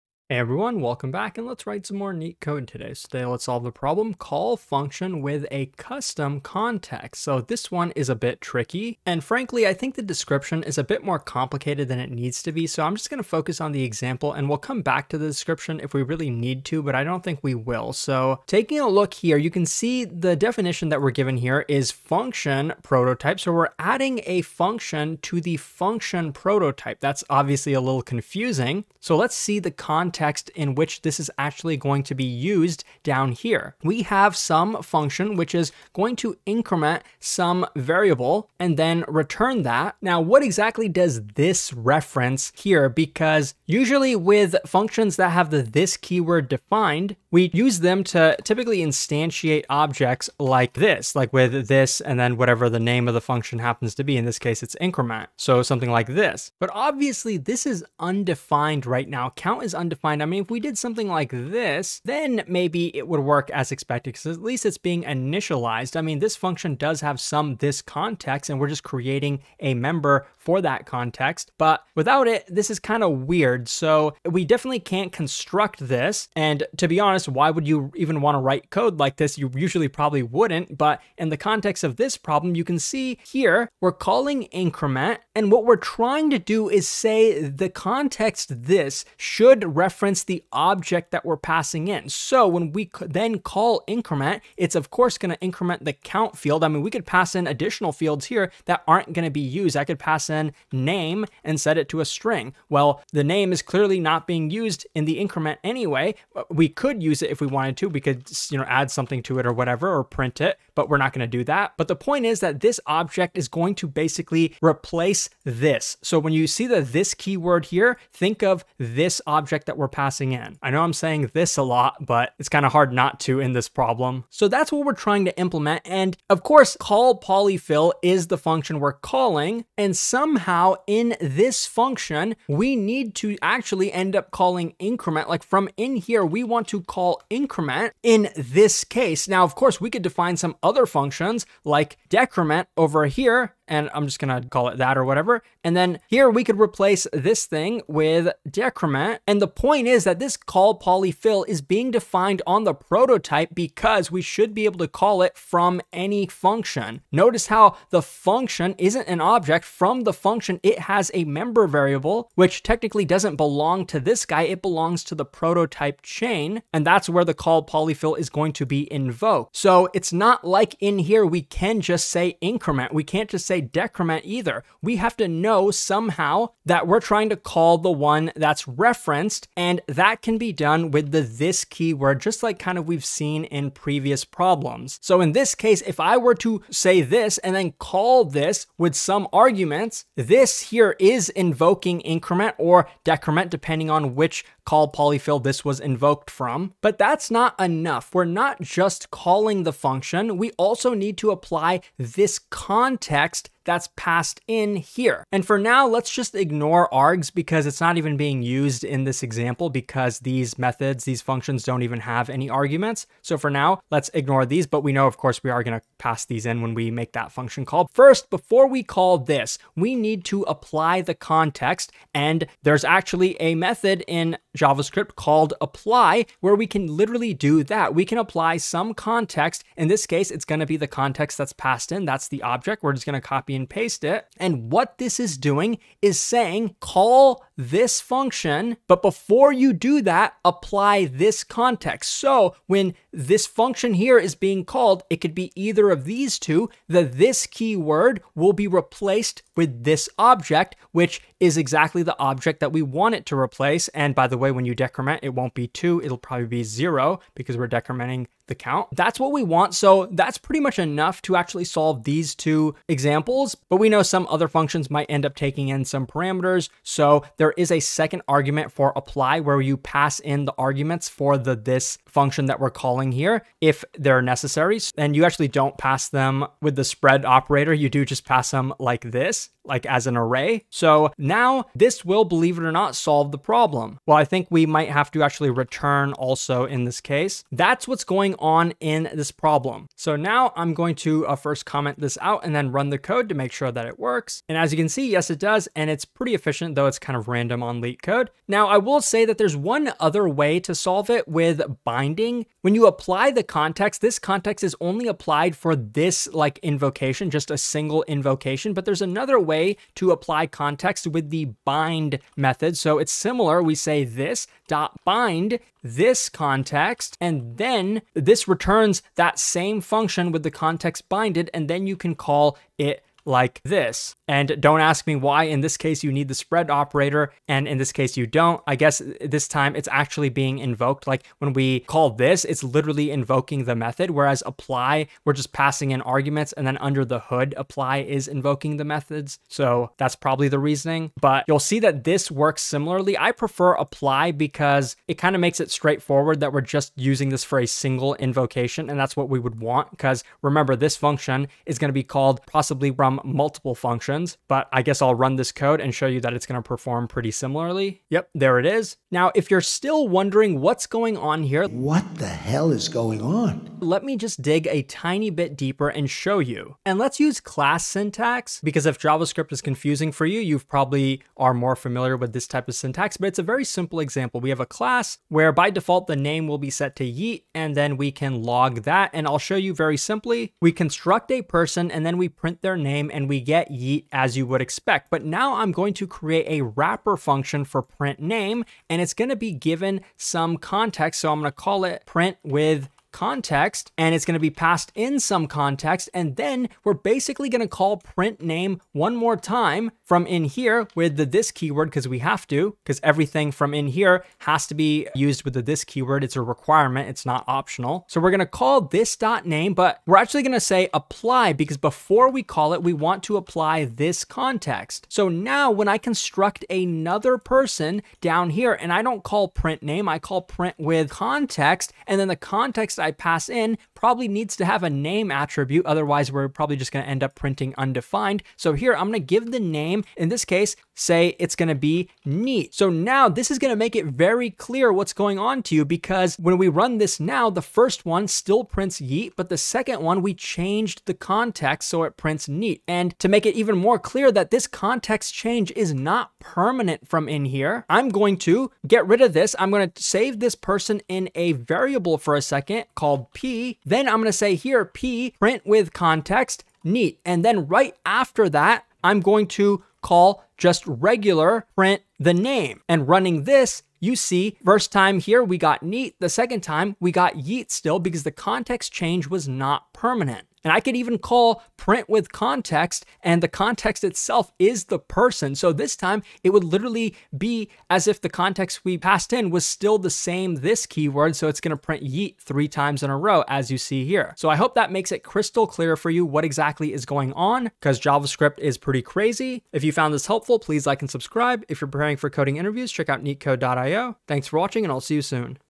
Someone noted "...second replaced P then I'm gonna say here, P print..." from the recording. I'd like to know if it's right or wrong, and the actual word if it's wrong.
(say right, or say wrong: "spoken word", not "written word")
wrong: "called", not "replaced".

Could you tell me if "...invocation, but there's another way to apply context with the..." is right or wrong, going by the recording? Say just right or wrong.
right.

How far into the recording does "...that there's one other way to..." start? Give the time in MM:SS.
04:59.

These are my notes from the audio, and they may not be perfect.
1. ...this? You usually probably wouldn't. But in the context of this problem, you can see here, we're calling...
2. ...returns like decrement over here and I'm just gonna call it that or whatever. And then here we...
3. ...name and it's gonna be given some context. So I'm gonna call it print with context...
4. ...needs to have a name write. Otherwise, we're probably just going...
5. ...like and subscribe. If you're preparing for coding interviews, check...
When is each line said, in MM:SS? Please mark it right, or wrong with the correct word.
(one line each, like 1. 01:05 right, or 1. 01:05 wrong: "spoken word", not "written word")
1. 01:19 right
2. 02:20 wrong: "functions", not "returns"
3. 06:28 right
4. 07:04 wrong: "attribute", not "write"
5. 08:10 right.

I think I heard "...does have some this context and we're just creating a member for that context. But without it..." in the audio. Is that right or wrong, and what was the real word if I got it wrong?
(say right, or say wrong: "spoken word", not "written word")
right.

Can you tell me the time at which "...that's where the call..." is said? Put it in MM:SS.
02:46.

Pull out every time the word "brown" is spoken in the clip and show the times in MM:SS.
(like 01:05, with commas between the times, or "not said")
not said.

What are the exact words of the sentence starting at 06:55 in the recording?
So now when I construct another person down here and I don't call print name, I call print with context.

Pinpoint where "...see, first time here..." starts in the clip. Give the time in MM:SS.
07:44.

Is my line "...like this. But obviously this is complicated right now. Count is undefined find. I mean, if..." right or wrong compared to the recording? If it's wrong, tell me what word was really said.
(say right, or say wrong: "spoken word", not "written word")
wrong: "undefined", not "complicated".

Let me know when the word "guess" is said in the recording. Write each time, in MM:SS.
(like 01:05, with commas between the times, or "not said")
05:28, 05:54.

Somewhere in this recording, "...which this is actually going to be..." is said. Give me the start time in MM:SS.
00:30.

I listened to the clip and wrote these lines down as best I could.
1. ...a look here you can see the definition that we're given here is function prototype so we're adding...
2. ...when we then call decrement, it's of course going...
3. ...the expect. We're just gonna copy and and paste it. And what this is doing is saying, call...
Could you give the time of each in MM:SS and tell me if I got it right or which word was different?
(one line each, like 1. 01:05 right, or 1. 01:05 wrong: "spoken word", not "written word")
1. 00:18 right
2. 01:32 wrong: "increment", not "decrement"
3. 03:52 wrong: "object", not "expect".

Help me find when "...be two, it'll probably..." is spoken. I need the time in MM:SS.
04:15.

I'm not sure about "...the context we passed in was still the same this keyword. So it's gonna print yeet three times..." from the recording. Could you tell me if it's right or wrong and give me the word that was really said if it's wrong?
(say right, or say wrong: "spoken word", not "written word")
right.